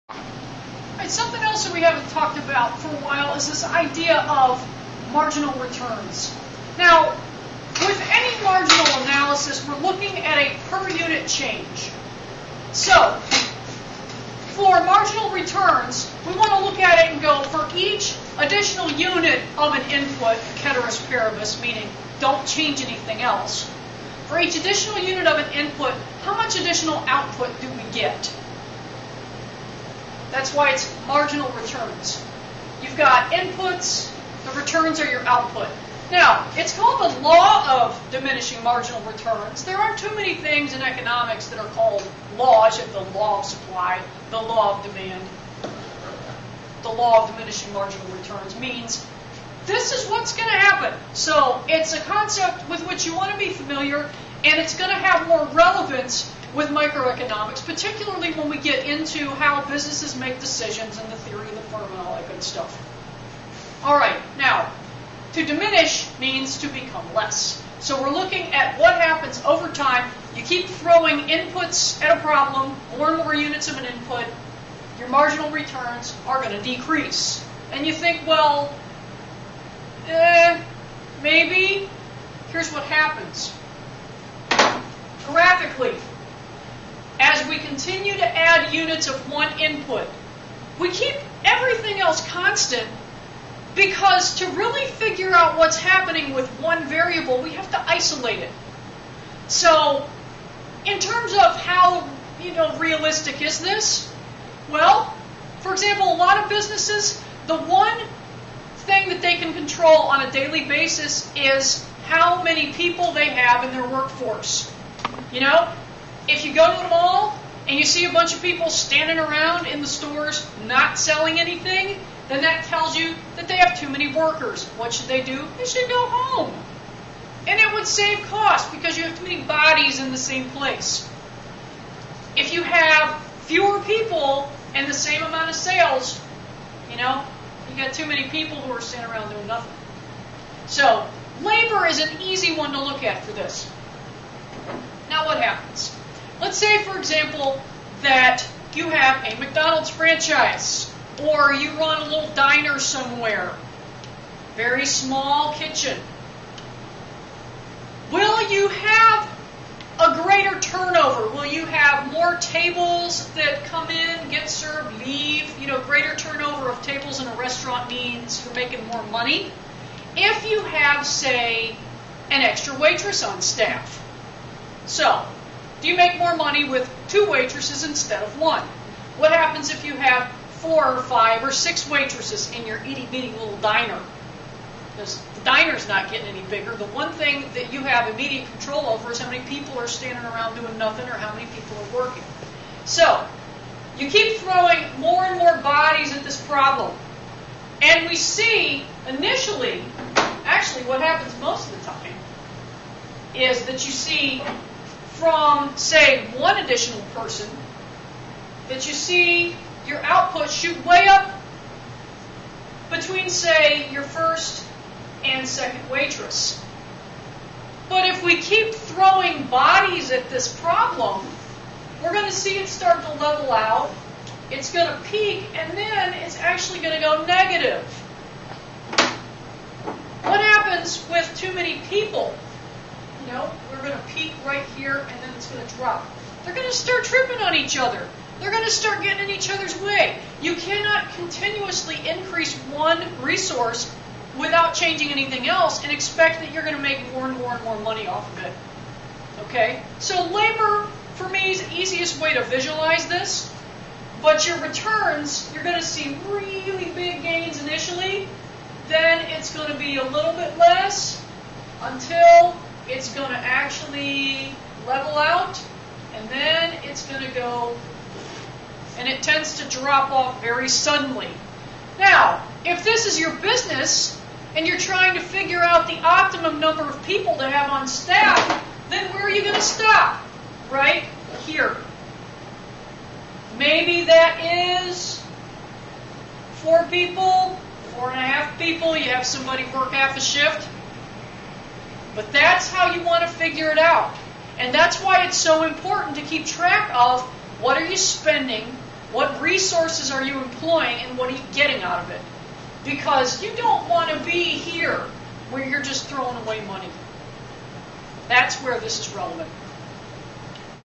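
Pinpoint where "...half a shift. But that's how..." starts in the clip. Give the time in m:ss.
4:49.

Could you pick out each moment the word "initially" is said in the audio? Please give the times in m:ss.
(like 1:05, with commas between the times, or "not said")
3:19, 4:17.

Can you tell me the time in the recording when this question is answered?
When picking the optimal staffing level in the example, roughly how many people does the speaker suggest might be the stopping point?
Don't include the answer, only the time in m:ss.
4:46.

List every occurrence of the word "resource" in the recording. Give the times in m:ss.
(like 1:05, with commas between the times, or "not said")
4:03, 4:59.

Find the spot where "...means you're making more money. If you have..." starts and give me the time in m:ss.
2:47.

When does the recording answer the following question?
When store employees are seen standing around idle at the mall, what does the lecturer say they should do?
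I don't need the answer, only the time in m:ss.
2:05.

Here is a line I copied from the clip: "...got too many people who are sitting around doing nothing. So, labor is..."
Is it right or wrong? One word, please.
right.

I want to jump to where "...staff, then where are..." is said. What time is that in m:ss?
4:37.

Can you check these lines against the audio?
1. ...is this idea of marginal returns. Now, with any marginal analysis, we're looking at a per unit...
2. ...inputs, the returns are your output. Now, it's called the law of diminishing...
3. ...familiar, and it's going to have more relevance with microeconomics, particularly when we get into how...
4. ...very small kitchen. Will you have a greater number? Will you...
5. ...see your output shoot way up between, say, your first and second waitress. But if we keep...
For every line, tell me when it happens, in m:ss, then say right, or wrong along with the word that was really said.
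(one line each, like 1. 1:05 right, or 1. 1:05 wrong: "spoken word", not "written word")
1. 0:03 right
2. 0:33 right
3. 0:53 right
4. 2:34 wrong: "turnover", not "number"
5. 3:28 right.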